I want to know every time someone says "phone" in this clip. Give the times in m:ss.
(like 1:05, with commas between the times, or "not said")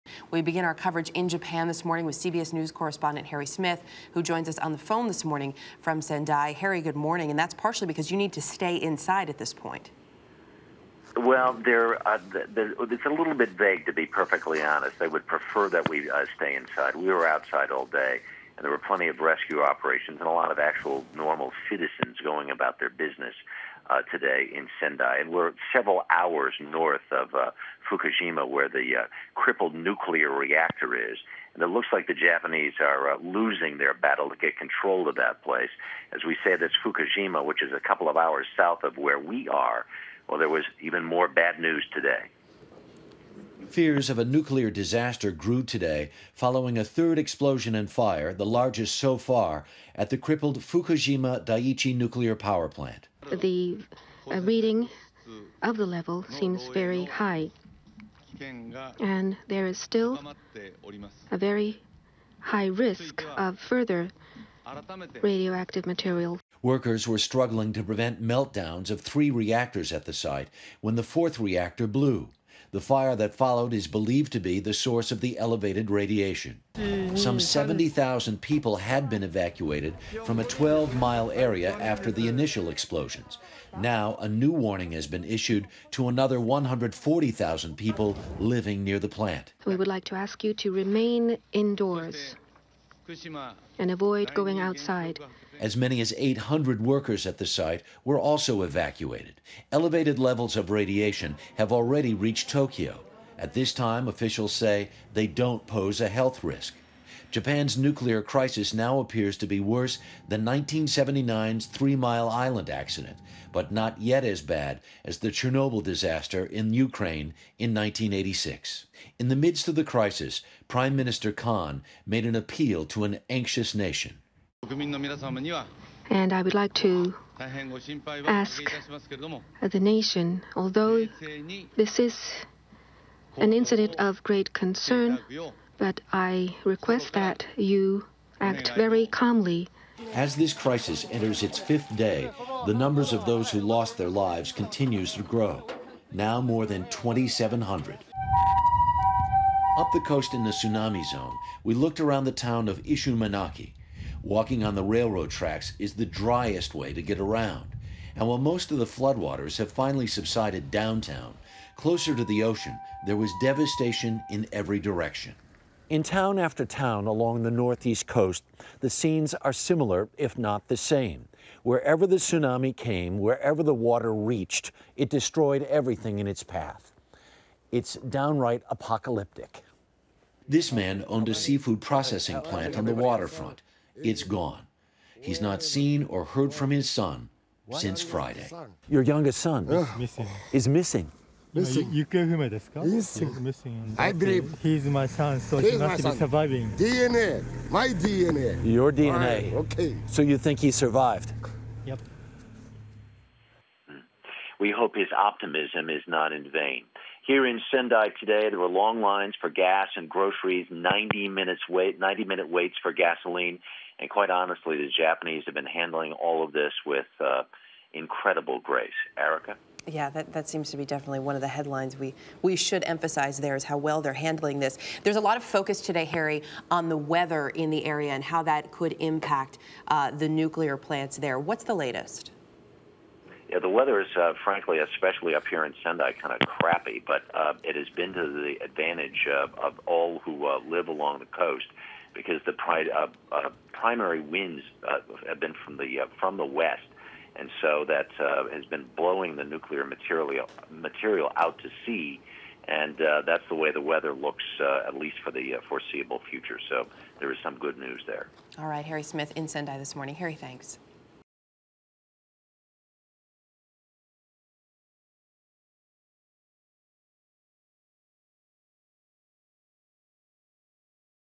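0:04.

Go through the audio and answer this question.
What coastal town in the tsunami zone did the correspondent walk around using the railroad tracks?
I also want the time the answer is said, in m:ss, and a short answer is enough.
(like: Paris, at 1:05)
Ishinomaki, at 2:32.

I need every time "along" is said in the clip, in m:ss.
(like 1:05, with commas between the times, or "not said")
2:47, 4:00.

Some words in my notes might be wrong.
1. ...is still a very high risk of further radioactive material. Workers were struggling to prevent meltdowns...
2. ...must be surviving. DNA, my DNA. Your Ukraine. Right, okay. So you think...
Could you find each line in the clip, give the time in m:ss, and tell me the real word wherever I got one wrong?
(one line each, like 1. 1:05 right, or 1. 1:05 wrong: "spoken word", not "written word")
1. 0:59 right
2. 3:15 wrong: "DNA", not "Ukraine".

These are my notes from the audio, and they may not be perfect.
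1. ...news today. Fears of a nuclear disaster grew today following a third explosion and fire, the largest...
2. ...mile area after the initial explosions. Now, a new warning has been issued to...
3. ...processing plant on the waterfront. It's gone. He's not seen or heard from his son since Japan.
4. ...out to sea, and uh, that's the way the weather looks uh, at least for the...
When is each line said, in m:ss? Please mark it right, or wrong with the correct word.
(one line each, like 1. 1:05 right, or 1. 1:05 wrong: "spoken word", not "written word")
1. 0:41 right
2. 1:20 right
3. 3:01 wrong: "Friday", not "Japan"
4. 4:11 right.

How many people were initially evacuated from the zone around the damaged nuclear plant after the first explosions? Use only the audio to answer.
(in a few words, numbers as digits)
70,000.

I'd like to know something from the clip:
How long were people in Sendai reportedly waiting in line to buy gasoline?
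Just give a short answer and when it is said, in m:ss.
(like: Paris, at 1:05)
90 minutes, at 3:31.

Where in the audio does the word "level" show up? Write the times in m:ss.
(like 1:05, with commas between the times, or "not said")
0:55, 1:40.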